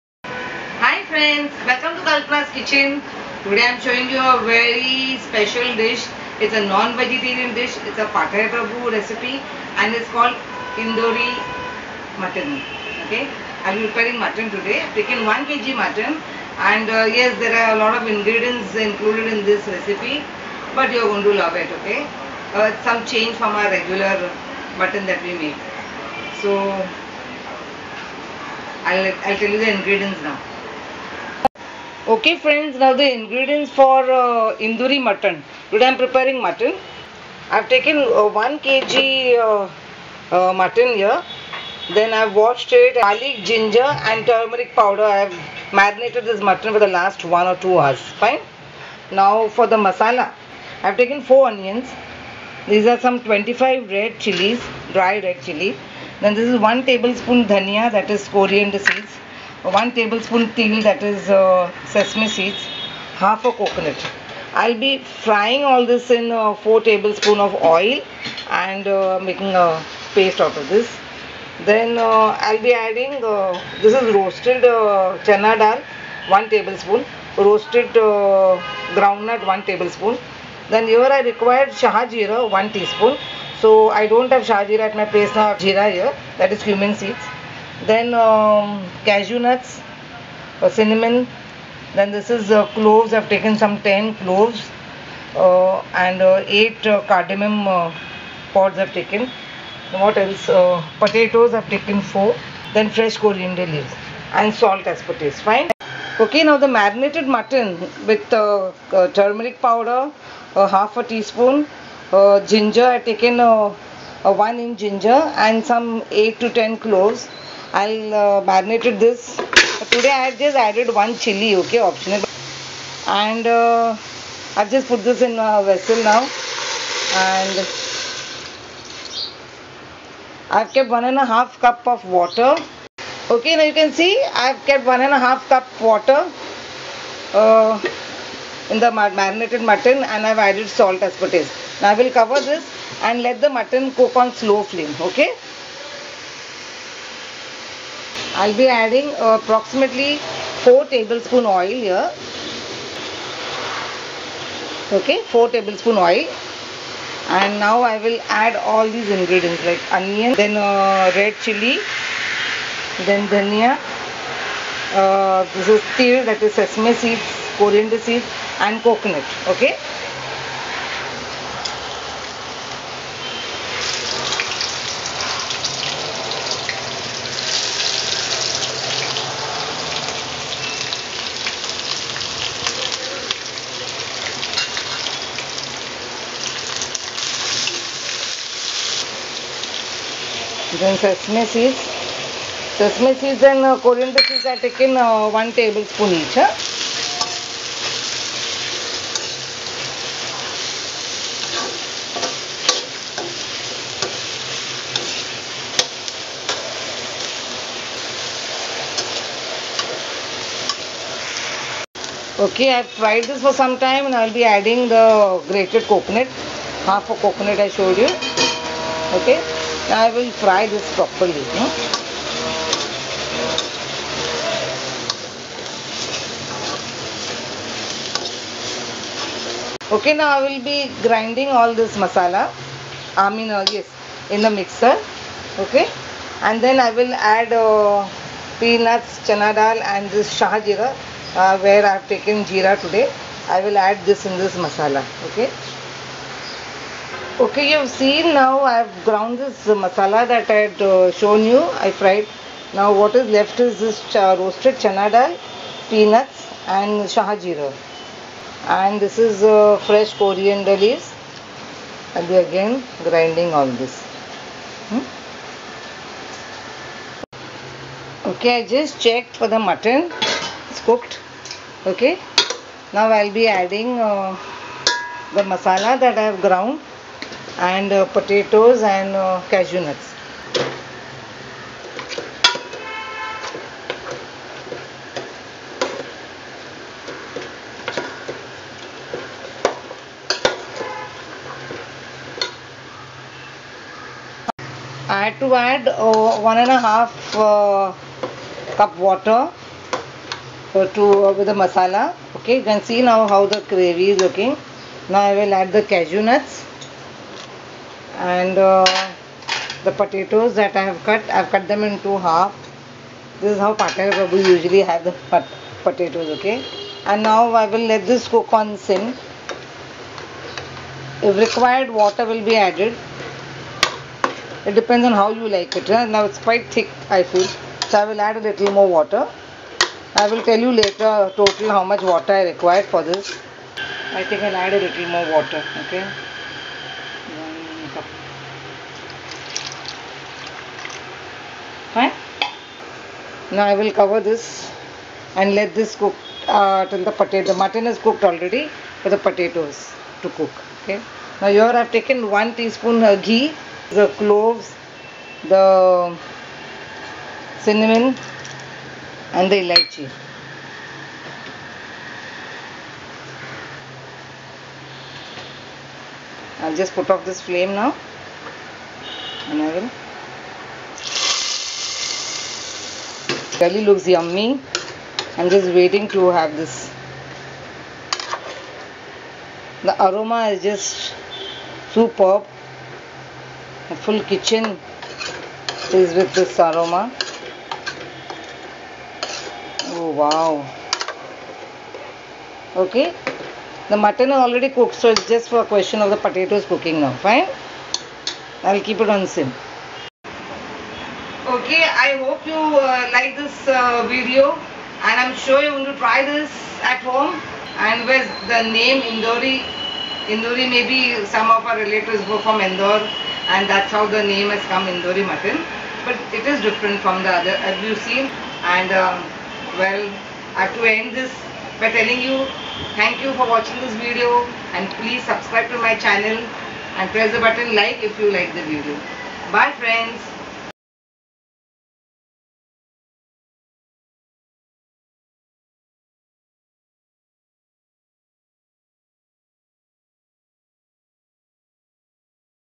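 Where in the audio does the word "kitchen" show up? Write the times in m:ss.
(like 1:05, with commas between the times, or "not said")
0:02, 6:24.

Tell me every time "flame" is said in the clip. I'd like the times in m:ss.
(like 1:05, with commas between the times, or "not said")
2:24, 6:07.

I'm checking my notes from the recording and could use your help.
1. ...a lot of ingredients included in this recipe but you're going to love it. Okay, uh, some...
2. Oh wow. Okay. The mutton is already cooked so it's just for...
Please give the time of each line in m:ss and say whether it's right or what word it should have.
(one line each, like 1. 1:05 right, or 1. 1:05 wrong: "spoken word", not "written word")
1. 0:17 right
2. 6:29 right.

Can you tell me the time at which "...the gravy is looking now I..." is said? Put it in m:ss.
5:03.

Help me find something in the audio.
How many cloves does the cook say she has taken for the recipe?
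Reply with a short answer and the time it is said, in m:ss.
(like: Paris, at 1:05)
10, at 1:33.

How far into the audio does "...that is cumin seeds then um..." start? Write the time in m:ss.
1:26.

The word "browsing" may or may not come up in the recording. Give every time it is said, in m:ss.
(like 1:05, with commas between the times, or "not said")
not said.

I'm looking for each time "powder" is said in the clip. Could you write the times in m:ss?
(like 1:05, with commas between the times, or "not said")
0:44, 1:49.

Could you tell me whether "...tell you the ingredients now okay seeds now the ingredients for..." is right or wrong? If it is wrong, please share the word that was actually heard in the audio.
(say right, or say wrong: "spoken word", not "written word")
wrong: "friends", not "seeds".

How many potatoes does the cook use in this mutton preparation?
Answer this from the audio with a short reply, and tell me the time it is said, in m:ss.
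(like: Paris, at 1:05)
4, at 1:40.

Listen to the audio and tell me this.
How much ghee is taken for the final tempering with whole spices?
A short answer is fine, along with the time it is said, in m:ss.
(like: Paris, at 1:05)
1 teaspoon, at 5:52.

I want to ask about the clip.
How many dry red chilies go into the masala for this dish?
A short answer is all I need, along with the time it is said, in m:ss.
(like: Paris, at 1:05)
25, at 0:53.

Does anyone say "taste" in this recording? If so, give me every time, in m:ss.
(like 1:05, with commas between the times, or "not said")
1:45, 2:21.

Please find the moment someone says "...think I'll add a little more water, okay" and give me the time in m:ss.
5:34.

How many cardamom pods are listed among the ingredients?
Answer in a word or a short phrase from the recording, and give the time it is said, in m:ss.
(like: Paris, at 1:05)
8, at 1:36.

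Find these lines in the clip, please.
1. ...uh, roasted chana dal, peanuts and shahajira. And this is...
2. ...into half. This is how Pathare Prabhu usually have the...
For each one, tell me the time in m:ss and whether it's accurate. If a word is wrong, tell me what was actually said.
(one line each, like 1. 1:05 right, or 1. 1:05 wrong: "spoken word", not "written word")
1. 4:14 right
2. 5:11 right.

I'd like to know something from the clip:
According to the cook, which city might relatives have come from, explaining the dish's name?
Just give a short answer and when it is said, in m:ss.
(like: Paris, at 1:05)
Indore, at 6:52.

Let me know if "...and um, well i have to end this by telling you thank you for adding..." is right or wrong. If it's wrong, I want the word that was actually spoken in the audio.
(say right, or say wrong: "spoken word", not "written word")
wrong: "watching", not "adding".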